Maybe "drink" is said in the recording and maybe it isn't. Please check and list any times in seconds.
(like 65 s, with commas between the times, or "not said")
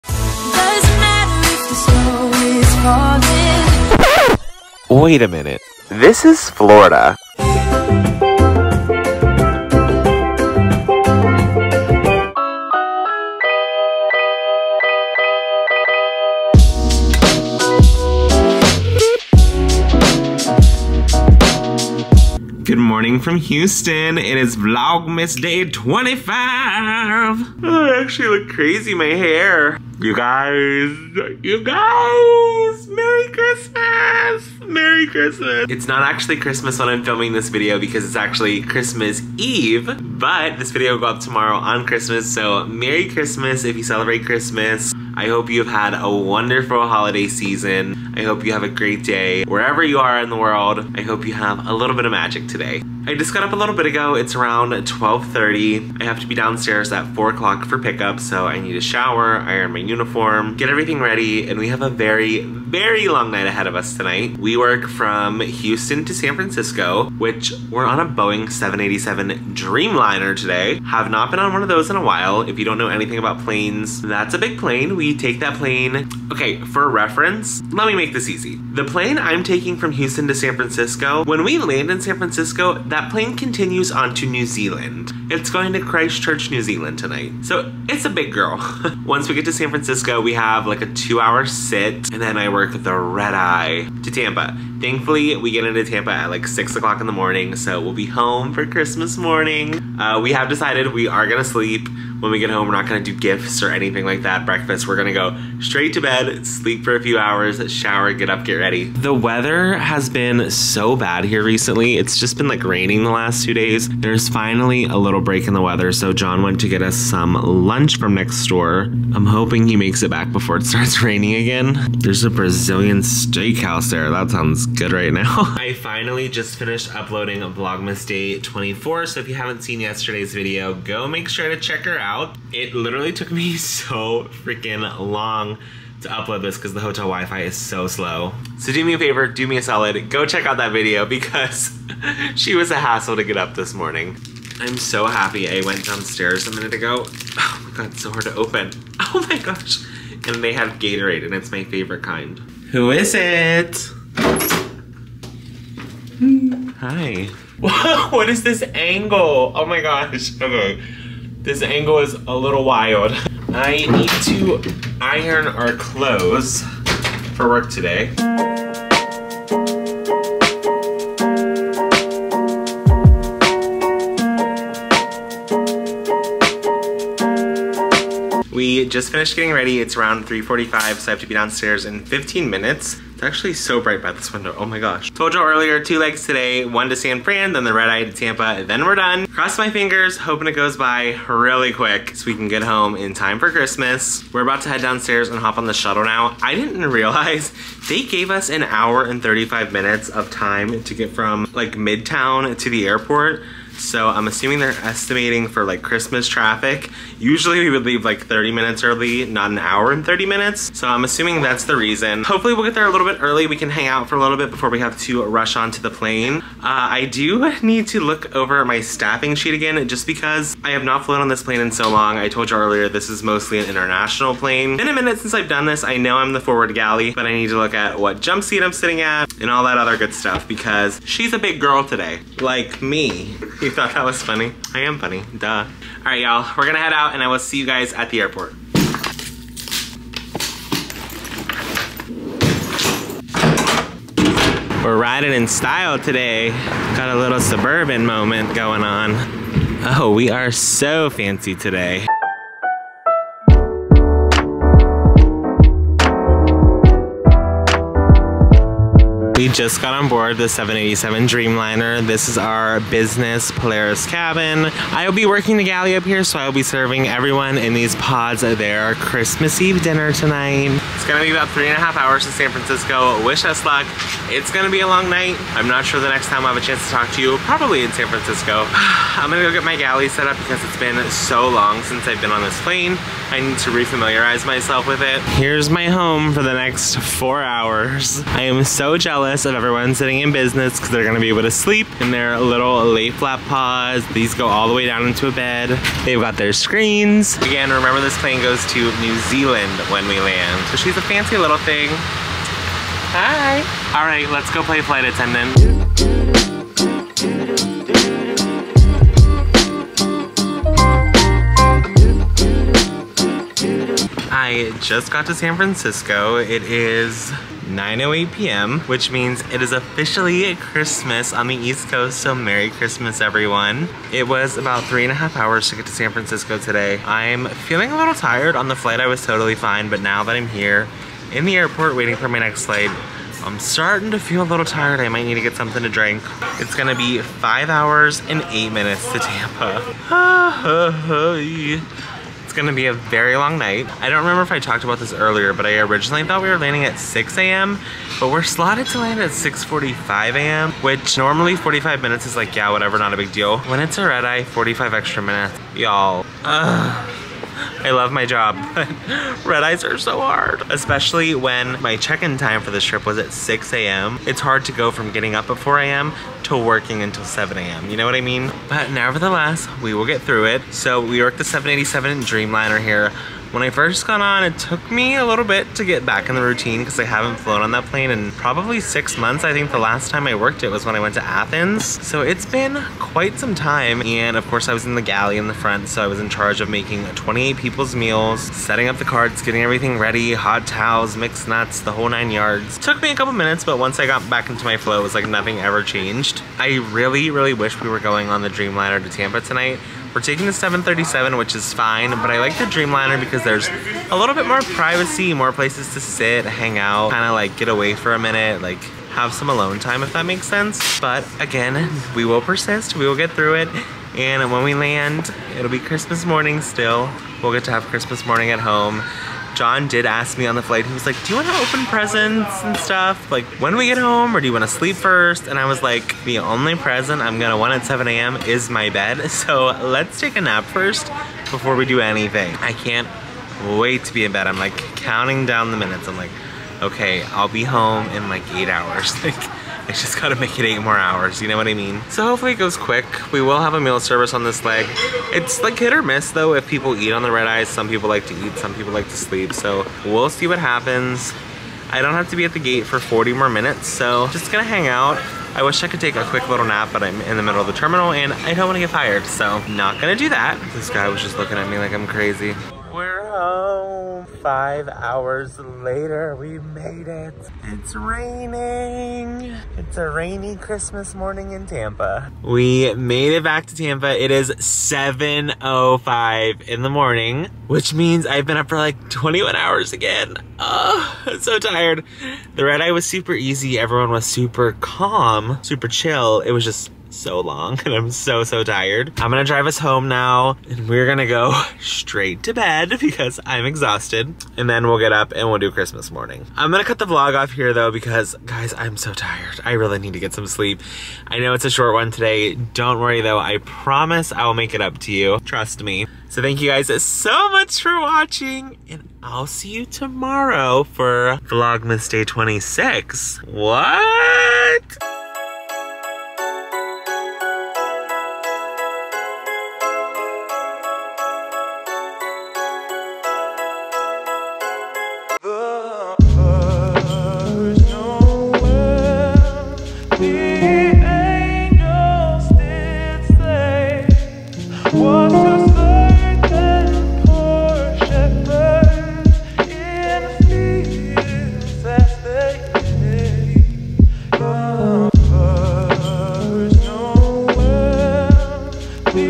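335 s.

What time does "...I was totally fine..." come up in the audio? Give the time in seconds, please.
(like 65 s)
328 s.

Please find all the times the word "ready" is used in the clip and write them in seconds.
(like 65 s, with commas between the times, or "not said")
61 s, 108 s, 179 s, 389 s.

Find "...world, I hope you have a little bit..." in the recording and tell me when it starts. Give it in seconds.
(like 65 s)
50 s.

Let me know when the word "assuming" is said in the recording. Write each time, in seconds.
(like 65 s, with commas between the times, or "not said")
204 s, 211 s.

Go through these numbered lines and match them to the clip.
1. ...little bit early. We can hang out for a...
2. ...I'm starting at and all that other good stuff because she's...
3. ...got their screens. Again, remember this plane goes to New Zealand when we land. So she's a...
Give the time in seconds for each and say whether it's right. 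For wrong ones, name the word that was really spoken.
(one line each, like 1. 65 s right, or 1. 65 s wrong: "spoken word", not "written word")
1. 212 s right
2. 228 s wrong: "sitting", not "starting"
3. 296 s right.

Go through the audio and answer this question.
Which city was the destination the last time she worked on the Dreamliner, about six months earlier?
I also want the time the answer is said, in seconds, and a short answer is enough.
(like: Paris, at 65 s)
Athens, at 381 s.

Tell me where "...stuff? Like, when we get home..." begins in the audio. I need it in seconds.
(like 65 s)
422 s.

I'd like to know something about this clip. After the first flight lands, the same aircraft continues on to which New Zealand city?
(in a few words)
Christchurch.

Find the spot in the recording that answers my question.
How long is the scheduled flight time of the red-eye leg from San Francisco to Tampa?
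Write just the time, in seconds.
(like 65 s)
337 s.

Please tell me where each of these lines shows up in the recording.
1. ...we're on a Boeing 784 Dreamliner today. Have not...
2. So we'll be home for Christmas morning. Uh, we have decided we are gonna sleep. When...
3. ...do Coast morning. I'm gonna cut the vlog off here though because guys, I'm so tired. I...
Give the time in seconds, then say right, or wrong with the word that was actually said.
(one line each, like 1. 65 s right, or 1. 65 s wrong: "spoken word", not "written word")
1. 67 s wrong: "787", not "784"
2. 97 s right
3. 495 s wrong: "Christmas", not "Coast".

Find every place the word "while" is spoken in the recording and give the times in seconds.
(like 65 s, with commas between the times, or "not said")
72 s.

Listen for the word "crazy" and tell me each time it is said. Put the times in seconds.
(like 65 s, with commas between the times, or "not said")
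28 s, 462 s.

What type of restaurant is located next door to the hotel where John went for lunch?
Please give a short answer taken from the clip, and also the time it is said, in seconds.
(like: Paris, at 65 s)
Brazilian steakhouse, at 122 s.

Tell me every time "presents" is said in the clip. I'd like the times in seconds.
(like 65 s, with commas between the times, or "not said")
421 s, 426 s.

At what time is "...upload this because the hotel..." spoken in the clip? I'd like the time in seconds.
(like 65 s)
136 s.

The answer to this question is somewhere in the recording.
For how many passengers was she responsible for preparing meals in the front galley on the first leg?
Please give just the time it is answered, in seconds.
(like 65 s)
387 s.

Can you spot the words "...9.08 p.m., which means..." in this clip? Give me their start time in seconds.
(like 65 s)
317 s.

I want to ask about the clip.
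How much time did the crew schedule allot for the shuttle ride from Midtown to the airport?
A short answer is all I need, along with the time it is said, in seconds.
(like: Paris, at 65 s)
1 hour and 35 minutes, at 198 s.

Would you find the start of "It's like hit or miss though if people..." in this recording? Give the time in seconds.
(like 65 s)
445 s.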